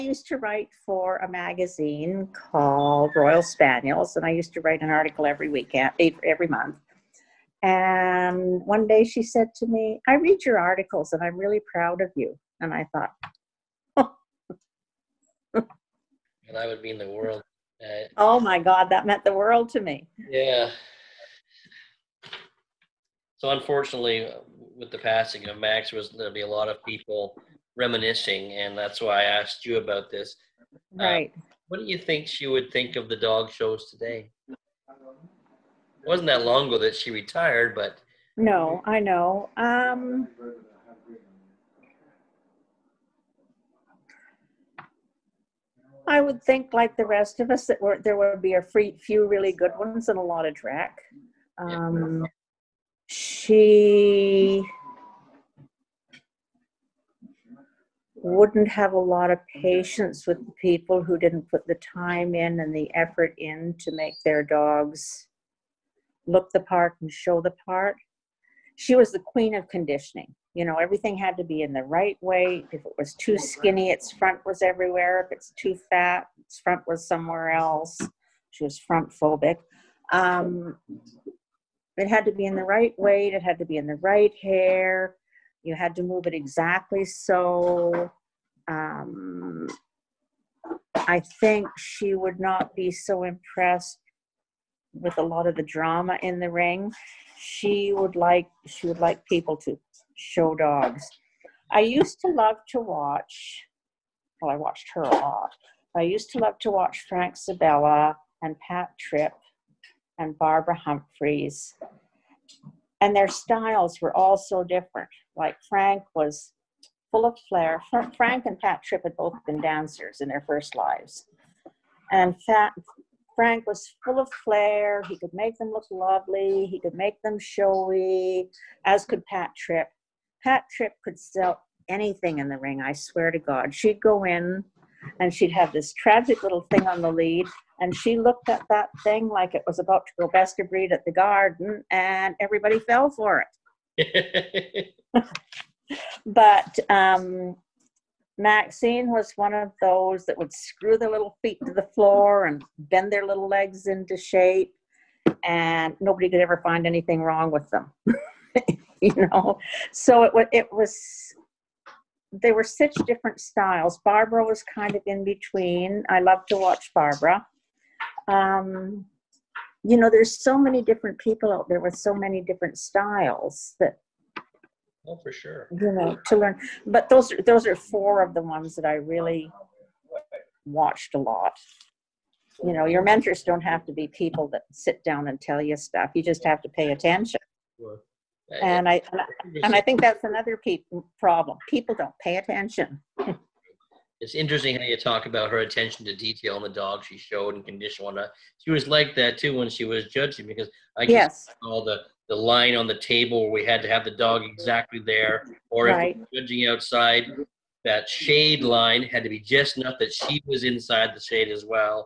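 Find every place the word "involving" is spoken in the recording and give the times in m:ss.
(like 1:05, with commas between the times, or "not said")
not said.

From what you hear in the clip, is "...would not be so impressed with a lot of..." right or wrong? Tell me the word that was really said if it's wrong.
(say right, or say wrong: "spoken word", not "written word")
right.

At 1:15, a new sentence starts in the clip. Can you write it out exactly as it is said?
If it's too fat, its front was somewhere else.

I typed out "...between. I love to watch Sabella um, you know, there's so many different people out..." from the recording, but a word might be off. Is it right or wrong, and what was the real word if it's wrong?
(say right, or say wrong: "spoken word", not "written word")
wrong: "Barbara", not "Sabella".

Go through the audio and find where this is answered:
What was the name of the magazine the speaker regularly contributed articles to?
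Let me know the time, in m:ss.
0:03.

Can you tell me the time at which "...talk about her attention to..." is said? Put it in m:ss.
3:14.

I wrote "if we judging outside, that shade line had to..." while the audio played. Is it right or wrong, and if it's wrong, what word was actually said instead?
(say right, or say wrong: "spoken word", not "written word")
right.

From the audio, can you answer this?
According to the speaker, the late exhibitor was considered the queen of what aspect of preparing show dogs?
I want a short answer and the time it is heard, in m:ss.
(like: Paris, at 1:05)
Conditioning, at 1:09.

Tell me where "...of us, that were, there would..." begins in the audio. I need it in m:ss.
0:47.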